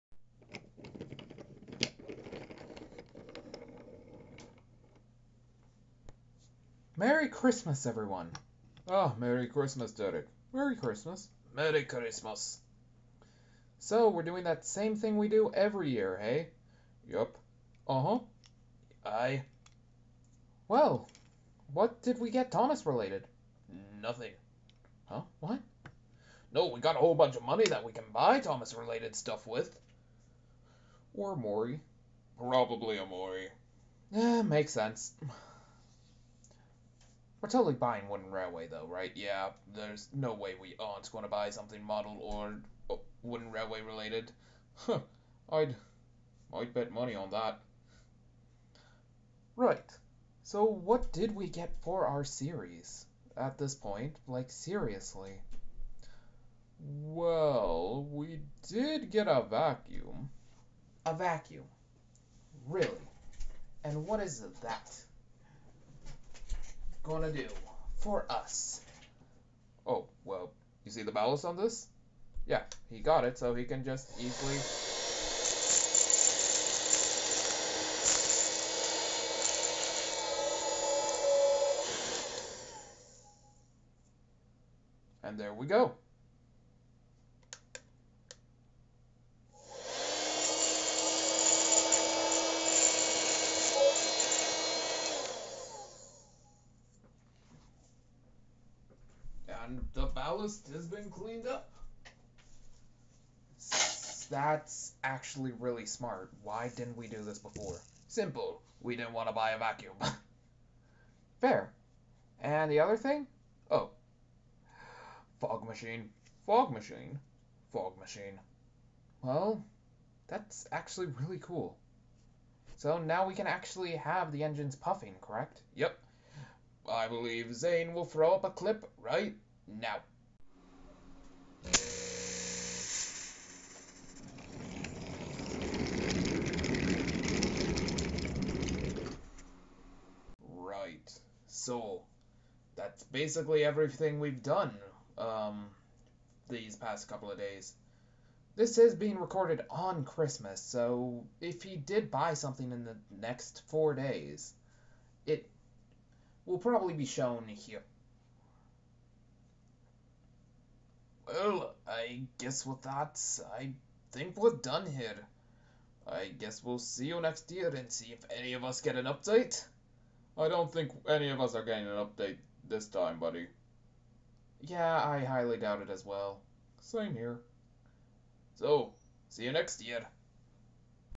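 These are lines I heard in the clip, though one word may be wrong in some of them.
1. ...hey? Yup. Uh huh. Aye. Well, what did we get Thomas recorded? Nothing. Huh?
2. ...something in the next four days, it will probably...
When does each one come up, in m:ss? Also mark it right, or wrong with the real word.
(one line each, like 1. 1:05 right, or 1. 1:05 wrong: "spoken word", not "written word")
1. 0:16 wrong: "related", not "recorded"
2. 2:32 right.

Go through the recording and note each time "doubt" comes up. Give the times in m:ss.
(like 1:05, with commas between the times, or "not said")
2:55.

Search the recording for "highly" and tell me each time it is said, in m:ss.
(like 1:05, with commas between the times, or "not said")
2:55.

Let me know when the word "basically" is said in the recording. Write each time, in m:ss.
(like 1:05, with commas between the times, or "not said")
2:23.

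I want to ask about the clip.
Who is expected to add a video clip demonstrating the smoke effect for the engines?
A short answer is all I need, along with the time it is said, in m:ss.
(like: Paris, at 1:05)
Zane, at 2:07.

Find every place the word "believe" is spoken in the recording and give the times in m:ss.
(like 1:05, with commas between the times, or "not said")
2:07.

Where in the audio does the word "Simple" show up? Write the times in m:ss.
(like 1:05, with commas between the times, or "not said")
1:48.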